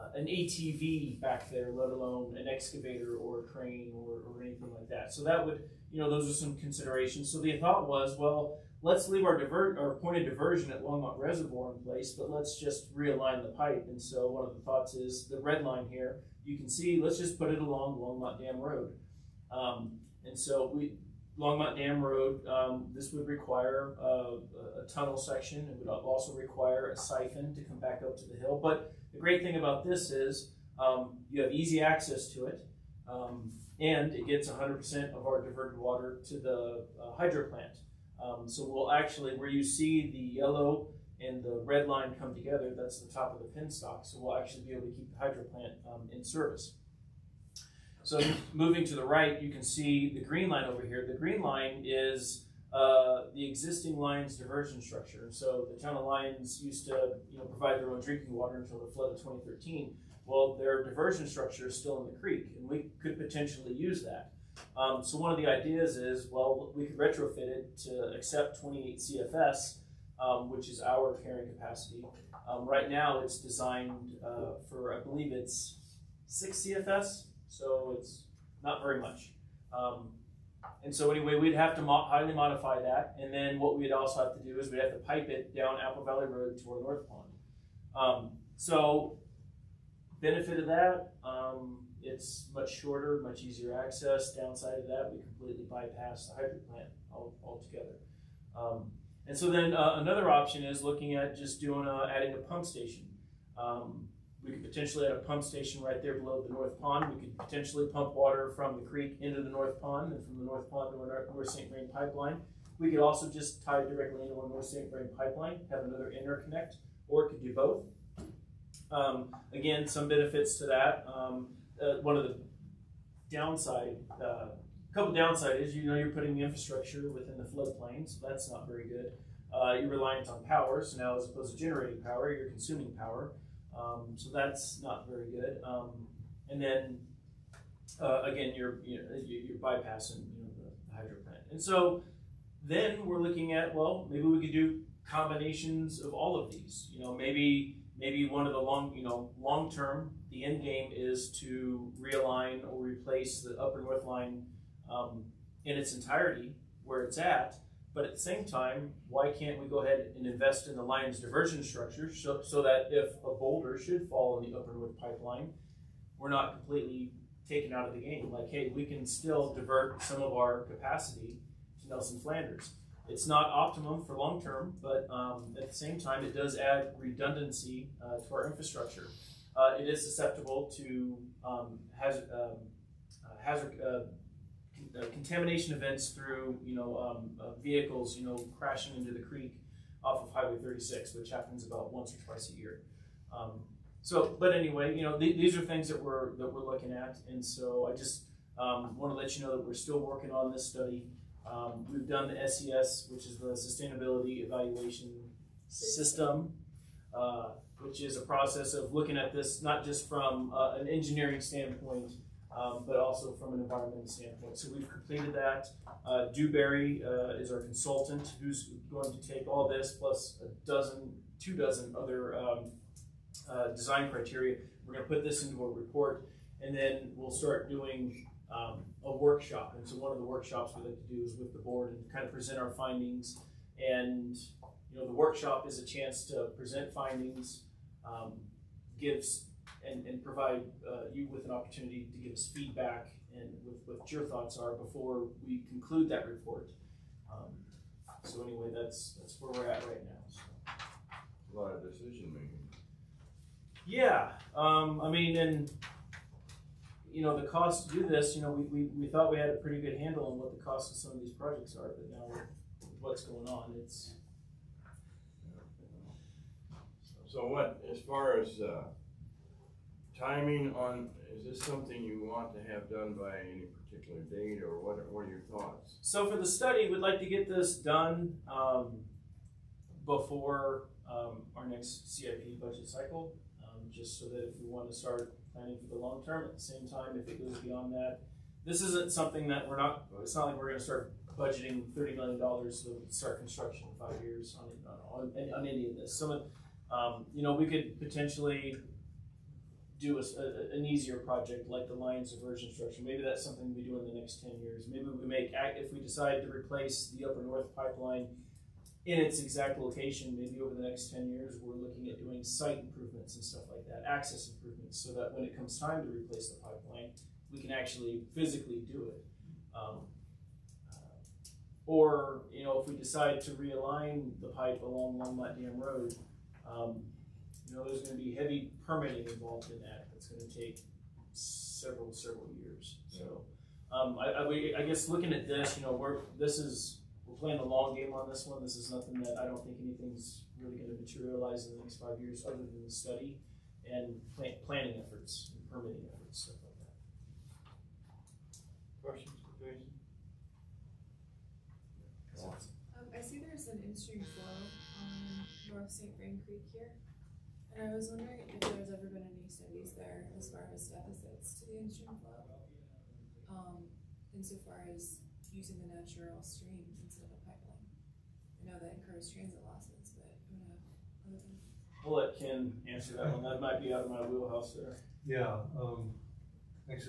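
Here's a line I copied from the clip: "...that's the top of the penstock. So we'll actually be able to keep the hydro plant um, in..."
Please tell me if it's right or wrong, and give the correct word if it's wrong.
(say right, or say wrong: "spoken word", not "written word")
right.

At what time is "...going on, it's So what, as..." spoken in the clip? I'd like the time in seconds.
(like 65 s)
263 s.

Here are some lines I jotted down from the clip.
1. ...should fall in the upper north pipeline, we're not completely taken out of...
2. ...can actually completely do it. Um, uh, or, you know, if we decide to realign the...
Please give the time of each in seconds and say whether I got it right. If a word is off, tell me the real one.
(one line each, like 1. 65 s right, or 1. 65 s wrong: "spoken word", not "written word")
1. 163 s right
2. 317 s wrong: "physically", not "completely".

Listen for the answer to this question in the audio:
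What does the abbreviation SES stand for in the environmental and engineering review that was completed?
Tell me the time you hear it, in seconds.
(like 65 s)
203 s.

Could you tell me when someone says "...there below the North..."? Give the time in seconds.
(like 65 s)
106 s.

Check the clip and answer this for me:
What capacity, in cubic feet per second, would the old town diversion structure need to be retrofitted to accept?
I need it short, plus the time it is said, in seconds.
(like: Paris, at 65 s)
28 CFS, at 68 s.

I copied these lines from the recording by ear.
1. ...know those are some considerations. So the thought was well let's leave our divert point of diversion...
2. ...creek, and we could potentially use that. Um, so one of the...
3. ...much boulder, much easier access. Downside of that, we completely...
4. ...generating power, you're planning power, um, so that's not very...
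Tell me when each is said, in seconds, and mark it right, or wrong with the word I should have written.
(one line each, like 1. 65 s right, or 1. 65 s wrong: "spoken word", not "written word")
1. 6 s right
2. 62 s right
3. 92 s wrong: "shorter", not "boulder"
4. 131 s wrong: "consuming", not "planning".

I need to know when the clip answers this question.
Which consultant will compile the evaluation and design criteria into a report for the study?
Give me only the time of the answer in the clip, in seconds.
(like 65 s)
216 s.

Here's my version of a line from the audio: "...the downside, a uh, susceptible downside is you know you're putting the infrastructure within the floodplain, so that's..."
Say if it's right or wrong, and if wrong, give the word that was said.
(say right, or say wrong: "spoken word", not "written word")
wrong: "couple", not "susceptible".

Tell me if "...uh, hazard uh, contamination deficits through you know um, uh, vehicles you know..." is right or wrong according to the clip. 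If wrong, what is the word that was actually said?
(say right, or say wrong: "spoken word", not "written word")
wrong: "events", not "deficits".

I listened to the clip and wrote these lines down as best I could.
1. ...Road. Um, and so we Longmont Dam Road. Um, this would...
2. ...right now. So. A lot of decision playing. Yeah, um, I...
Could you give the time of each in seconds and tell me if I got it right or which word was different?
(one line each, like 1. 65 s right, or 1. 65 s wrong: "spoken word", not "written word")
1. 18 s right
2. 249 s wrong: "making", not "playing".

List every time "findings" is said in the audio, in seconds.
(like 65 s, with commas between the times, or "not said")
232 s, 236 s.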